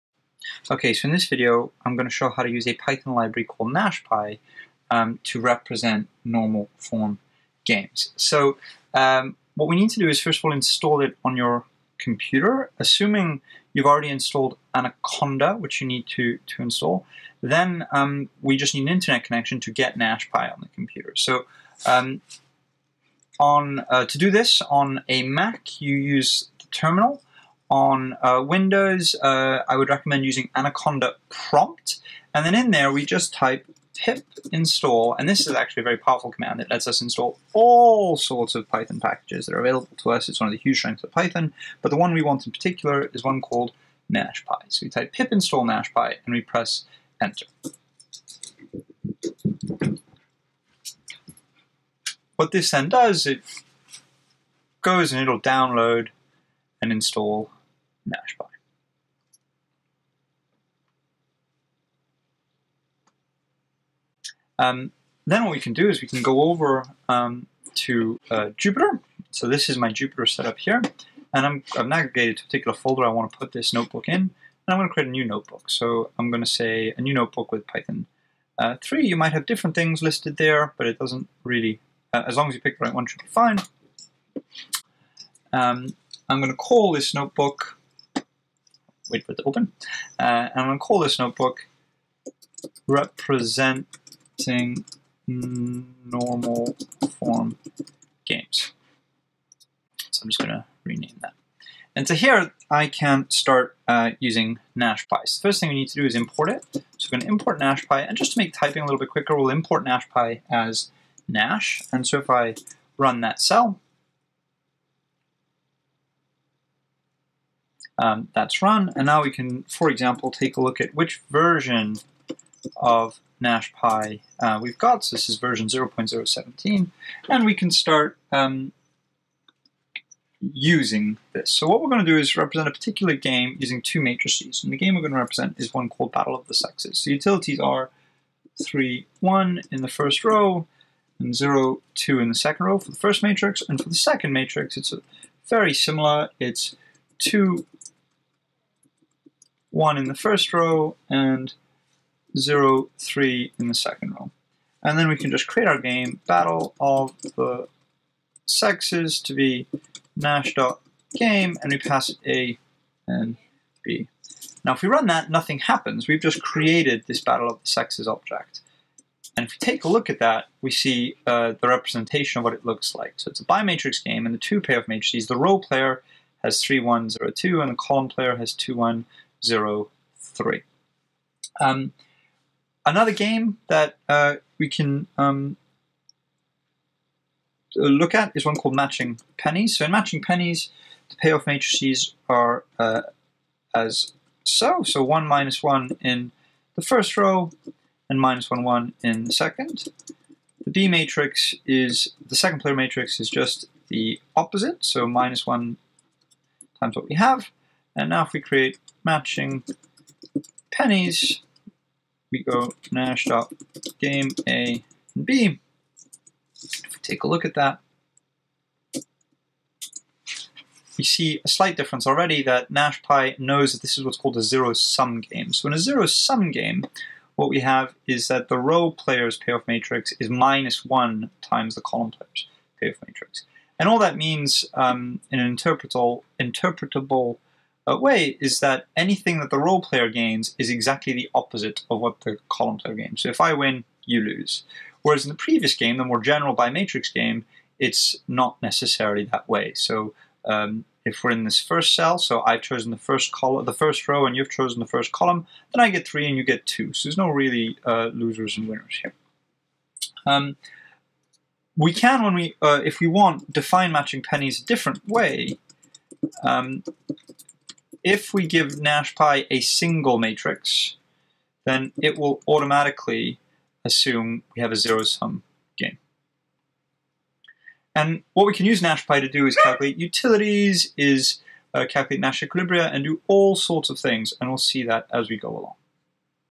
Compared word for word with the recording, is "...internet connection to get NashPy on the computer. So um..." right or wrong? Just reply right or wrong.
right.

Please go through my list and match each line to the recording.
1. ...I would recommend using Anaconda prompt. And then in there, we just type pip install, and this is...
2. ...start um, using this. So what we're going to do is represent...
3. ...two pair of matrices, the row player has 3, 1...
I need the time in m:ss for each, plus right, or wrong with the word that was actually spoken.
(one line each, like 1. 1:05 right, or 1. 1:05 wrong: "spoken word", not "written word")
1. 0:29 right
2. 2:07 right
3. 2:54 right.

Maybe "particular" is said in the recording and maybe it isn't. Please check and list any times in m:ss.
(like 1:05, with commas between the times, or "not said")
0:42, 1:12, 2:12.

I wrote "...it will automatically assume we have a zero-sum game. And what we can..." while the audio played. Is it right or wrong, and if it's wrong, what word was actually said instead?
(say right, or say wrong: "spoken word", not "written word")
right.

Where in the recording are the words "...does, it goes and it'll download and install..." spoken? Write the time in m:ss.
0:52.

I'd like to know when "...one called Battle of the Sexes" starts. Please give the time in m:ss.
2:15.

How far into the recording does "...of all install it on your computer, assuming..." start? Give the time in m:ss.
0:10.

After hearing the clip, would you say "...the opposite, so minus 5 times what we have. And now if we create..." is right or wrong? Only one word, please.
wrong.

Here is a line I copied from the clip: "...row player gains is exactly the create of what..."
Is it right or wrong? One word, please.
wrong.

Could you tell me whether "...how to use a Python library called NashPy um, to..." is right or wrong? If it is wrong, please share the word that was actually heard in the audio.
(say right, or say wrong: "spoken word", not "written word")
right.